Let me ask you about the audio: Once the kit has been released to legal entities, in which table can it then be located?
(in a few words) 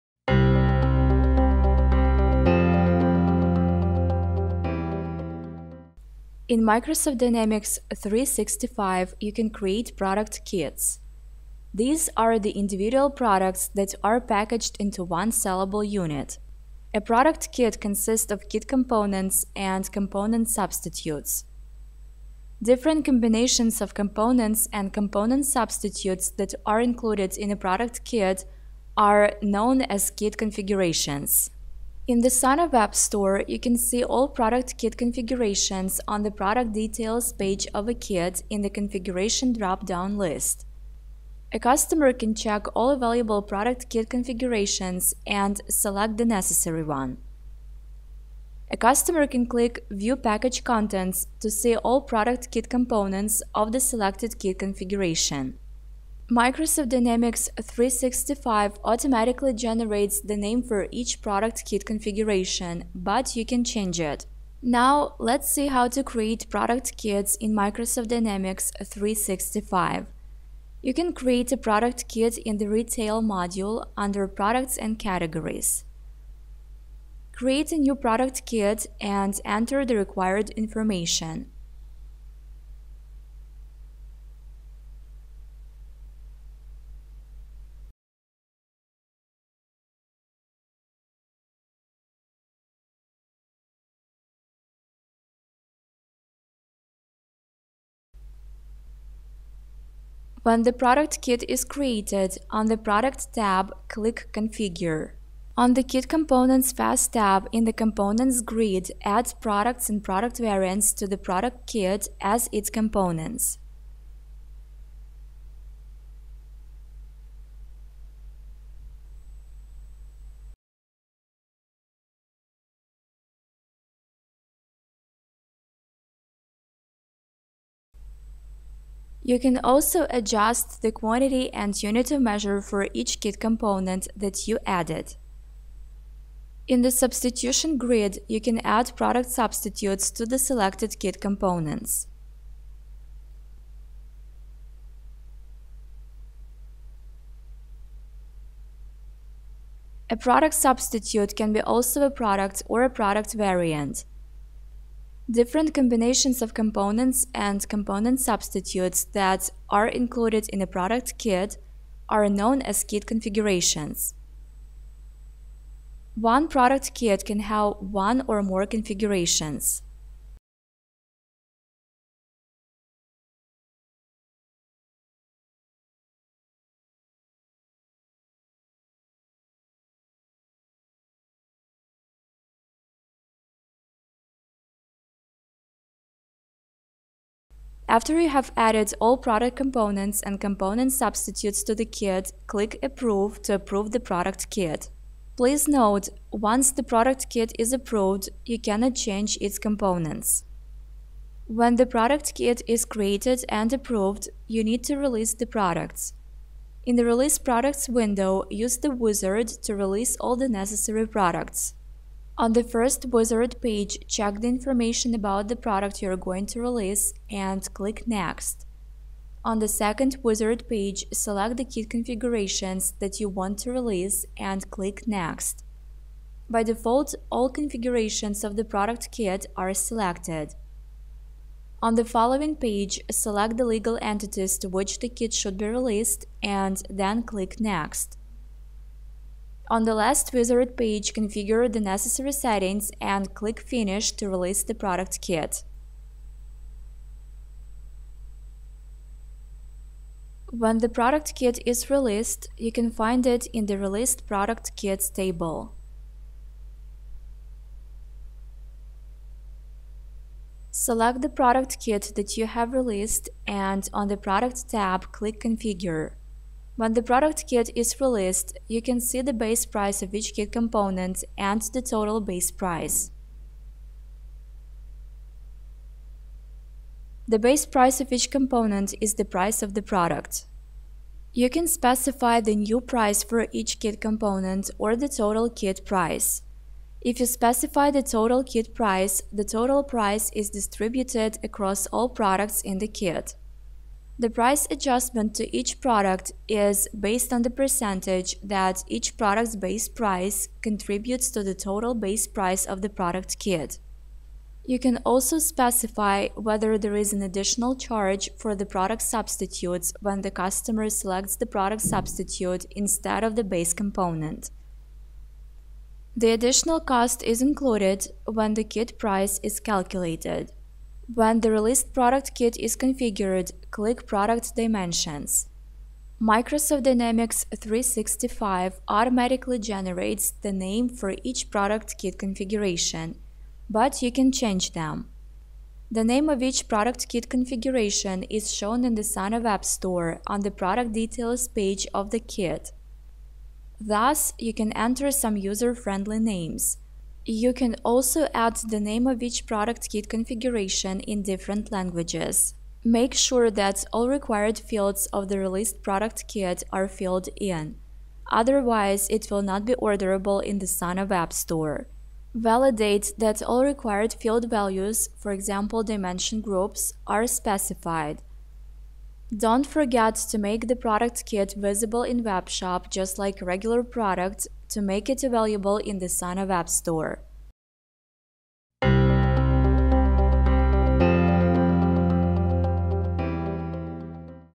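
Released Product Kits.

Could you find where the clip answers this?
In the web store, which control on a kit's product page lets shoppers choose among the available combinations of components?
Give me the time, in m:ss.
0:38.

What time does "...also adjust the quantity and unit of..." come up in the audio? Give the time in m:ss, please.
2:09.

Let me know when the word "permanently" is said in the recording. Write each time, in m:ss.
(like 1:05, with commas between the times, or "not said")
not said.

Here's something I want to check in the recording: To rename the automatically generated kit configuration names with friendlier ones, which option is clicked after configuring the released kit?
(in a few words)
Product Dimensions.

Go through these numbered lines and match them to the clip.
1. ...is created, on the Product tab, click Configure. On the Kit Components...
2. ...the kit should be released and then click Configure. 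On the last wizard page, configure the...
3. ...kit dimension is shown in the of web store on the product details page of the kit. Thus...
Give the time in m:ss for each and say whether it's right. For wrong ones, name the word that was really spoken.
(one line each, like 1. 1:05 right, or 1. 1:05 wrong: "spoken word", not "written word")
1. 1:41 right
2. 3:54 wrong: "Next", not "Configure"
3. 5:37 wrong: "configuration", not "dimension".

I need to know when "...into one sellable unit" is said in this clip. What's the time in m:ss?
0:14.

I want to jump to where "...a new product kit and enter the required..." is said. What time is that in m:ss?
1:17.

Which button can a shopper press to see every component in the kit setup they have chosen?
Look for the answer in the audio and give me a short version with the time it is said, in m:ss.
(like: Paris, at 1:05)
View Package Contents, at 0:49.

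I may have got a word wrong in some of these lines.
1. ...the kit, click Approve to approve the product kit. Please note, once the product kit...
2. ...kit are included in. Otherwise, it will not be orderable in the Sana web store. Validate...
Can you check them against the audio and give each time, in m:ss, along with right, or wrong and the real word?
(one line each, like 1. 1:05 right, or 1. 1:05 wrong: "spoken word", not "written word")
1. 3:11 right
2. 5:56 wrong: "filled", not "included".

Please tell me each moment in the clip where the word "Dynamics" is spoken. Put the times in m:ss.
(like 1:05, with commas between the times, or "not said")
0:07, 0:56, 1:08, 5:26.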